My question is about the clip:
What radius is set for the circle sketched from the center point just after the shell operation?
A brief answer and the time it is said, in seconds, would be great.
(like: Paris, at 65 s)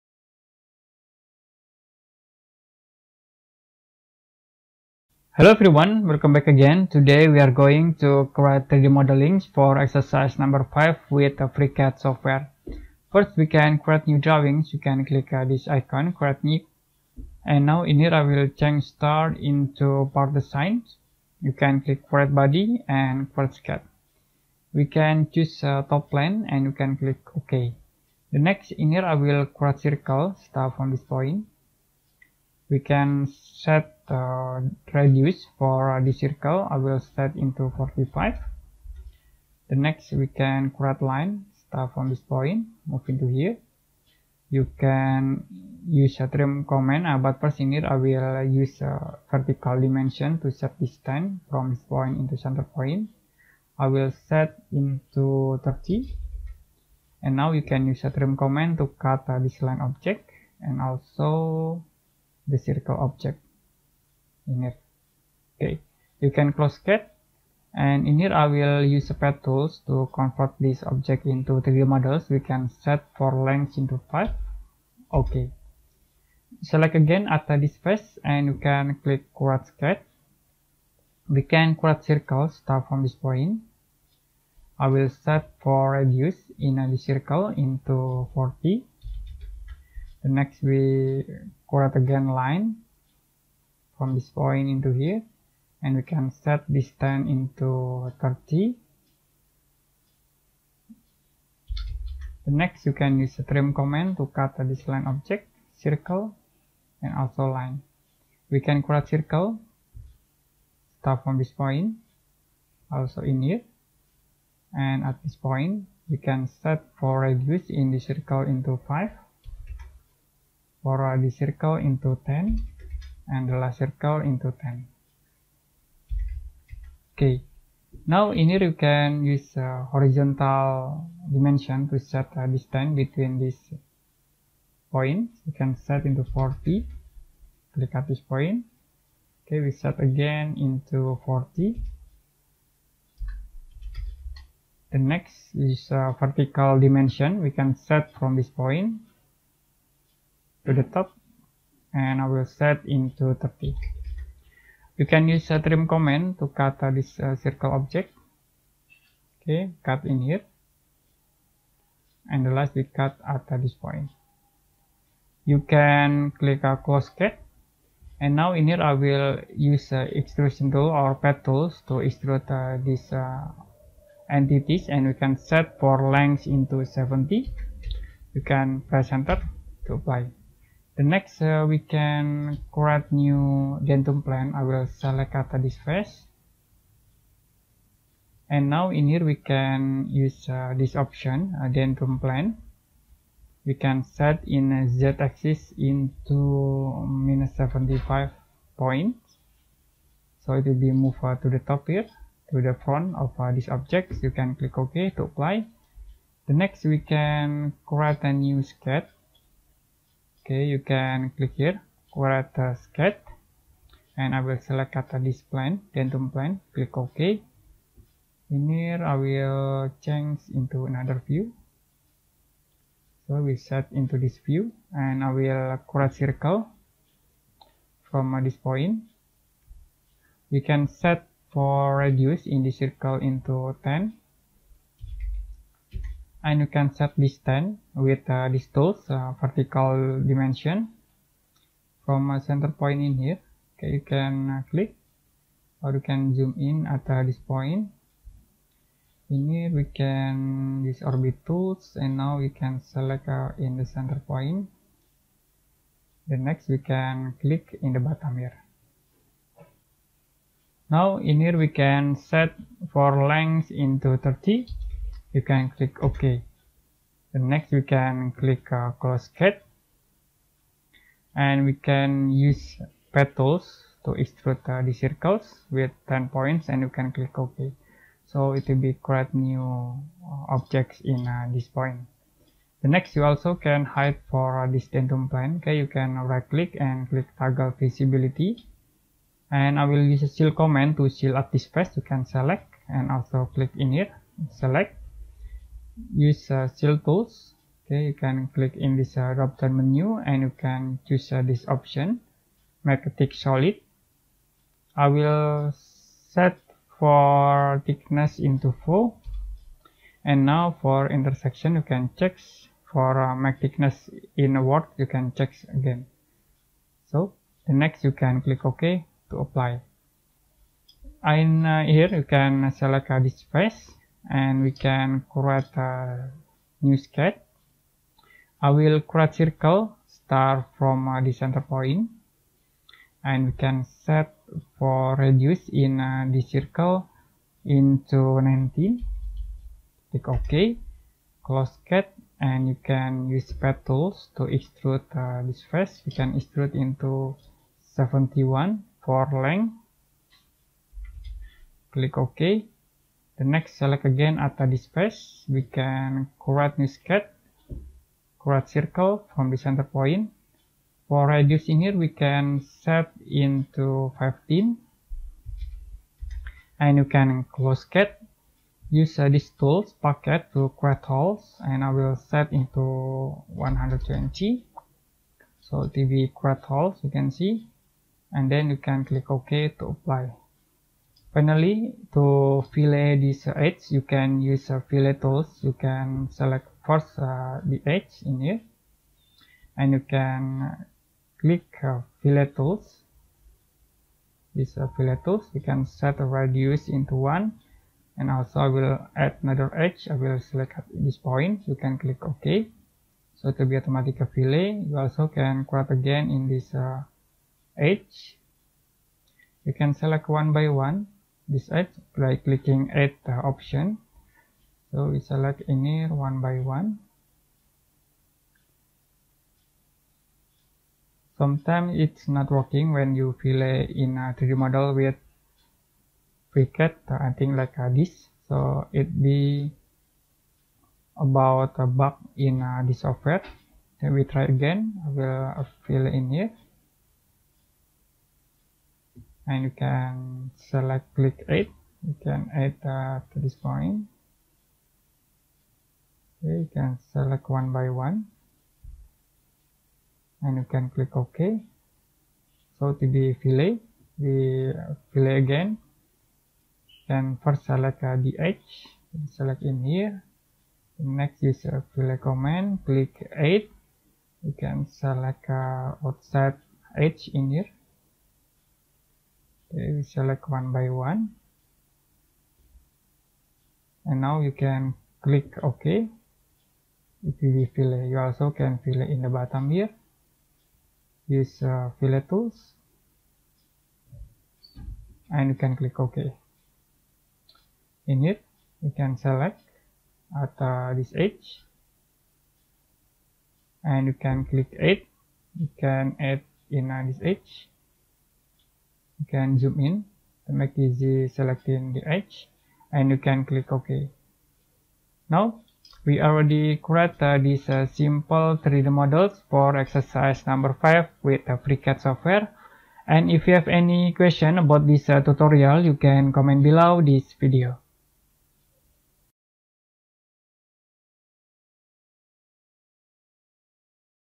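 19, at 338 s.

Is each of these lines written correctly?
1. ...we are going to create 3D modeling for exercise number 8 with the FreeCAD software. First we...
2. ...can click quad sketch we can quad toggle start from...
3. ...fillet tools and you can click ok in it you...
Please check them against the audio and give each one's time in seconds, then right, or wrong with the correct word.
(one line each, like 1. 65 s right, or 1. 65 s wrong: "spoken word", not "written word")
1. 7 s wrong: "5", not "8"
2. 78 s wrong: "circle", not "toggle"
3. 481 s right.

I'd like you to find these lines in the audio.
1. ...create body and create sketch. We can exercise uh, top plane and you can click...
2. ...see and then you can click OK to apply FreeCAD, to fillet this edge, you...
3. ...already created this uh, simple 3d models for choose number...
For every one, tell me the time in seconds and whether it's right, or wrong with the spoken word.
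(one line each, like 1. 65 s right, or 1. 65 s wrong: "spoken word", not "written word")
1. 22 s wrong: "choose", not "exercise"
2. 377 s wrong: "Finally", not "FreeCAD"
3. 506 s wrong: "exercise", not "choose".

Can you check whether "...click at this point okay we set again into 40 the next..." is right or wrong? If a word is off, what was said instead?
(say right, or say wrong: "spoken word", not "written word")
right.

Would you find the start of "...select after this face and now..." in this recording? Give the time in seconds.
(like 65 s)
185 s.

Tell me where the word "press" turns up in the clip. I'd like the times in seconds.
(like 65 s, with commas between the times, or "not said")
178 s.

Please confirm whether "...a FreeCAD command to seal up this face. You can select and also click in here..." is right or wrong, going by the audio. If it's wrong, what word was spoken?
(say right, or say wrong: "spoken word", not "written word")
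wrong: "Seal", not "FreeCAD".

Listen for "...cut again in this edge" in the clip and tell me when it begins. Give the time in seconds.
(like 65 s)
405 s.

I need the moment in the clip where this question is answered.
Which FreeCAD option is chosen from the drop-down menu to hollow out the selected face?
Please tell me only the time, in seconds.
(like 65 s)
302 s.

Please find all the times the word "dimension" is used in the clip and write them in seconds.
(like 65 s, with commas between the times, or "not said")
49 s, 131 s, 146 s, 240 s.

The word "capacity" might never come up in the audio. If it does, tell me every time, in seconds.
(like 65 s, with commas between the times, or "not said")
not said.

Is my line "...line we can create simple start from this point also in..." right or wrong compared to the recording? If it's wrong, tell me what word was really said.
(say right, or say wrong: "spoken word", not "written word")
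wrong: "circle", not "simple".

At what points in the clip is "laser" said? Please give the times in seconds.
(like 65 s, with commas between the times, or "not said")
not said.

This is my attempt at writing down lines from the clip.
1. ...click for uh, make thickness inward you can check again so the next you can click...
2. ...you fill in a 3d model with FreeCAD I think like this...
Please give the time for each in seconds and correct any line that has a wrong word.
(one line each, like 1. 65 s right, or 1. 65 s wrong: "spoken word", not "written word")
1. 312 s wrong: "check", not "click"
2. 423 s right.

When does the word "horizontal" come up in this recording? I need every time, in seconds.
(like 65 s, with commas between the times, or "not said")
129 s.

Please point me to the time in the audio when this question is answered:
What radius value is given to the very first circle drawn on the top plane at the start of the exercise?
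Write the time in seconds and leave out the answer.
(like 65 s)
37 s.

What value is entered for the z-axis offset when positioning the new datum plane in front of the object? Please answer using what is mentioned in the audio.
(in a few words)
-75.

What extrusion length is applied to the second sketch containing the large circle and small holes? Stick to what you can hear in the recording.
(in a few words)
70.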